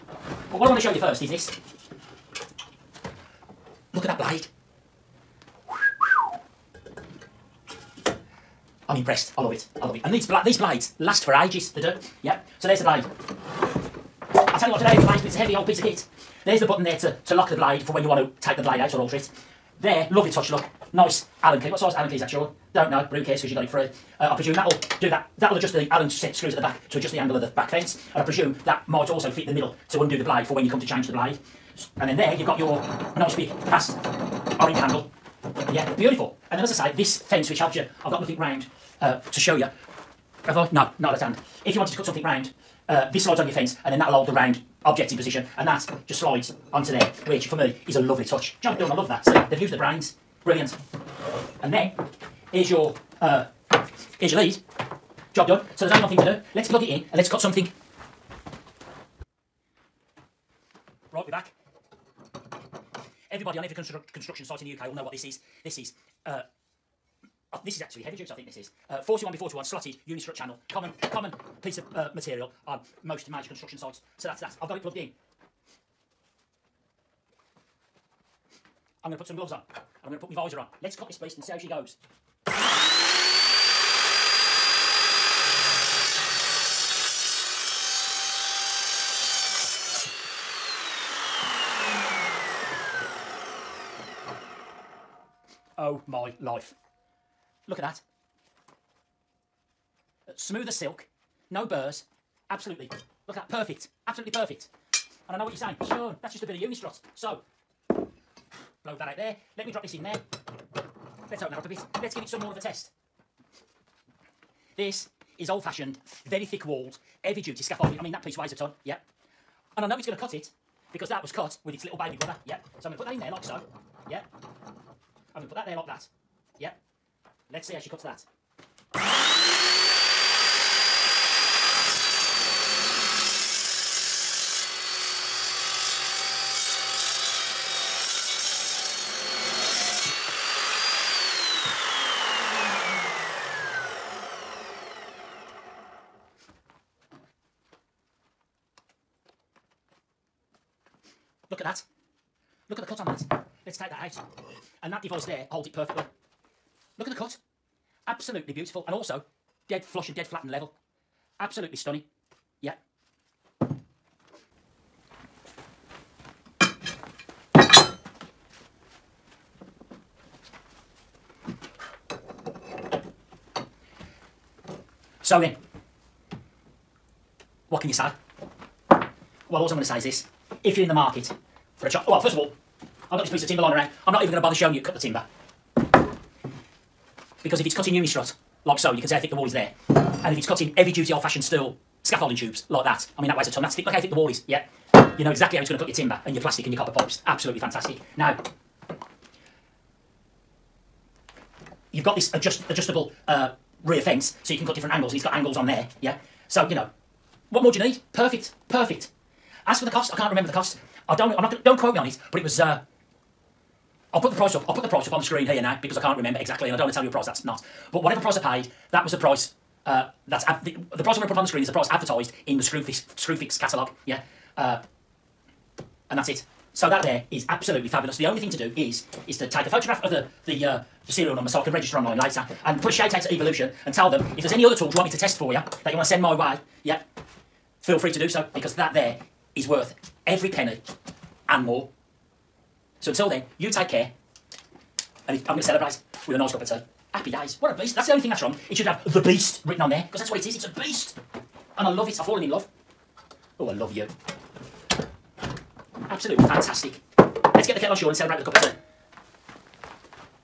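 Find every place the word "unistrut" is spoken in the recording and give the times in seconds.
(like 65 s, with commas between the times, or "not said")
70 s, 106 s, 187 s.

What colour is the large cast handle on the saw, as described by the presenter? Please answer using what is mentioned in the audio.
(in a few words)
Orange.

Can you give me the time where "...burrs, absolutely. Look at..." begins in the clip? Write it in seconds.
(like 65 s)
101 s.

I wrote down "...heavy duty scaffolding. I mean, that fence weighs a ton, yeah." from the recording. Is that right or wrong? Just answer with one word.
wrong.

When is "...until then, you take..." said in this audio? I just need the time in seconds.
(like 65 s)
243 s.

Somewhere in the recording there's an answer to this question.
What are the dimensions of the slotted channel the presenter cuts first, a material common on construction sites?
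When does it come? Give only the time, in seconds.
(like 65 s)
69 s.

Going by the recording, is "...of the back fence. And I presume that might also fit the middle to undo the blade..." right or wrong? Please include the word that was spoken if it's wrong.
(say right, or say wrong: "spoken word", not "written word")
right.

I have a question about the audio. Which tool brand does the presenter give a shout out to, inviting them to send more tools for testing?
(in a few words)
Evolution.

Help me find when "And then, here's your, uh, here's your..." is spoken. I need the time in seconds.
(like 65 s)
51 s.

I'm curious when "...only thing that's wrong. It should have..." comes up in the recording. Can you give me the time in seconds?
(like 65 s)
248 s.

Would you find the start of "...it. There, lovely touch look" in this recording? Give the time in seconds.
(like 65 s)
19 s.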